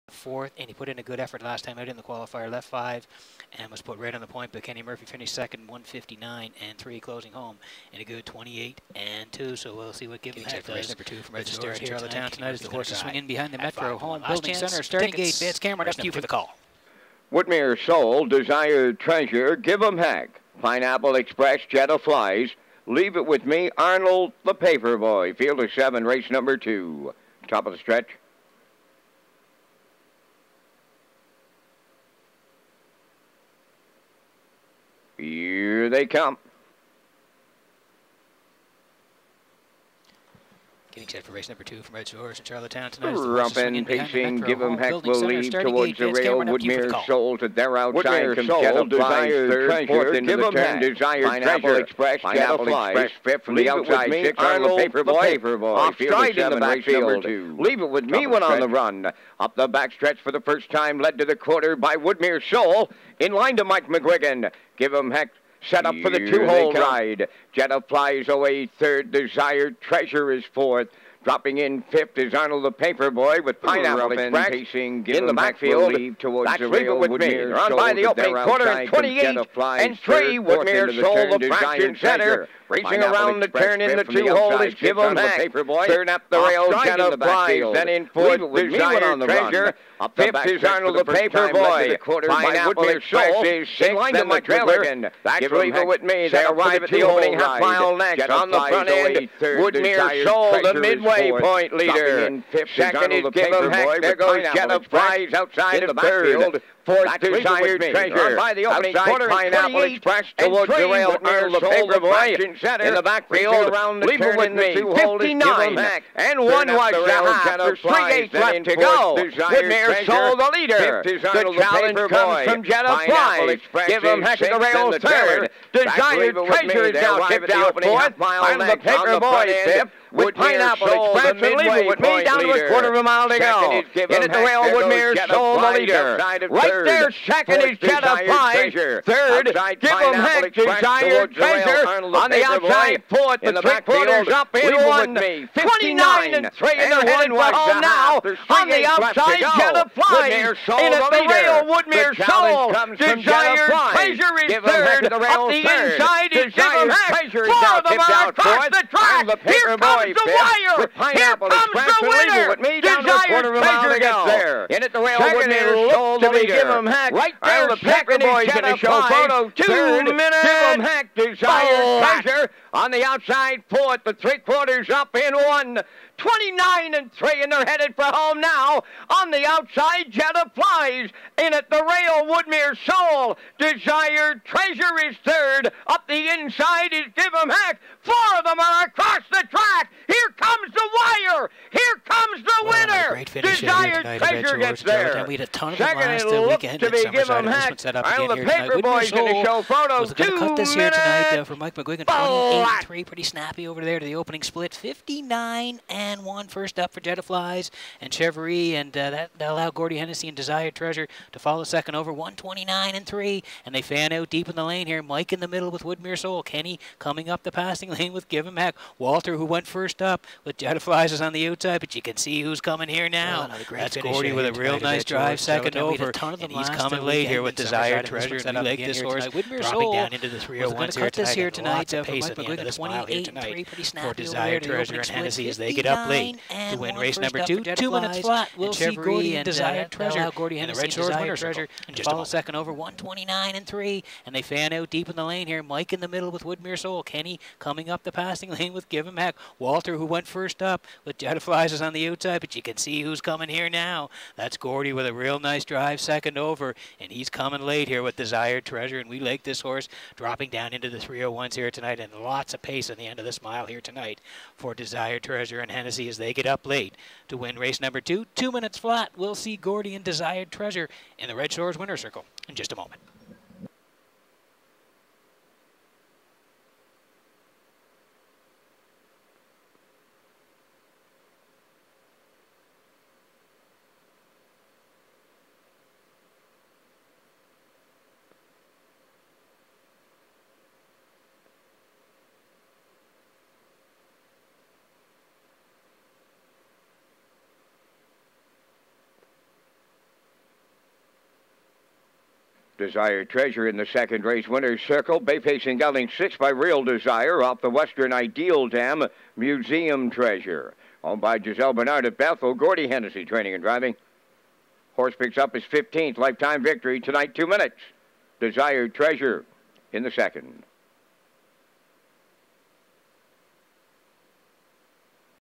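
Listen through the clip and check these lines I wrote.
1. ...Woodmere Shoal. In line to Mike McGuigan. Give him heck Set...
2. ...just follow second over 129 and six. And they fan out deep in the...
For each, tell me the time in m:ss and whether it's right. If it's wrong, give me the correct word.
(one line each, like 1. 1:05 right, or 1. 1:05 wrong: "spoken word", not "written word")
1. 1:01 right
2. 4:01 wrong: "three", not "six".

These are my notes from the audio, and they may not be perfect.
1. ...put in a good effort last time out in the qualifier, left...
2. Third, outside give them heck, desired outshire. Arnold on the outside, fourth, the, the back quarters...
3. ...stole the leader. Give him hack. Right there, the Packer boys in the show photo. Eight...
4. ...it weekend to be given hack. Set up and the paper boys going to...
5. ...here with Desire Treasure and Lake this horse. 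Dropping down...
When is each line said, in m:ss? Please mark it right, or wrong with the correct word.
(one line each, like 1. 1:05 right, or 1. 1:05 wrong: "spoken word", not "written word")
1. 0:00 right
2. 2:18 wrong: "treasure", not "outshire"
3. 2:45 wrong: "Two", not "Eight"
4. 3:16 right
5. 3:47 right.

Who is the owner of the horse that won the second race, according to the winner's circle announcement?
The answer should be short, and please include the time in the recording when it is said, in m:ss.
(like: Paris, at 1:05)
Giselle Bernard, at 5:11.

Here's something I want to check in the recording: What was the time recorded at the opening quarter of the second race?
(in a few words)
28 and 3.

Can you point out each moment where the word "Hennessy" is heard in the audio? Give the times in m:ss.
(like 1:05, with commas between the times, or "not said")
3:29, 3:55, 4:25, 5:12.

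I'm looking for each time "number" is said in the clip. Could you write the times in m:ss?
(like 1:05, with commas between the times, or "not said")
0:10, 0:26, 0:41, 3:57, 4:27.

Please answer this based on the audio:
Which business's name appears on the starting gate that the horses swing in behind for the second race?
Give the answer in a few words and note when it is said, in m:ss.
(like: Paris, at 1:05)
Metro Home Building Center, at 0:13.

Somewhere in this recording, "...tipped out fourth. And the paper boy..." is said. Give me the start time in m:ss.
2:07.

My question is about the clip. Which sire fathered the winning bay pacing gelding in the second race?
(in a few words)
Real Desire.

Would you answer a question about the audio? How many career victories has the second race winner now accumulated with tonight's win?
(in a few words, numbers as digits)
15.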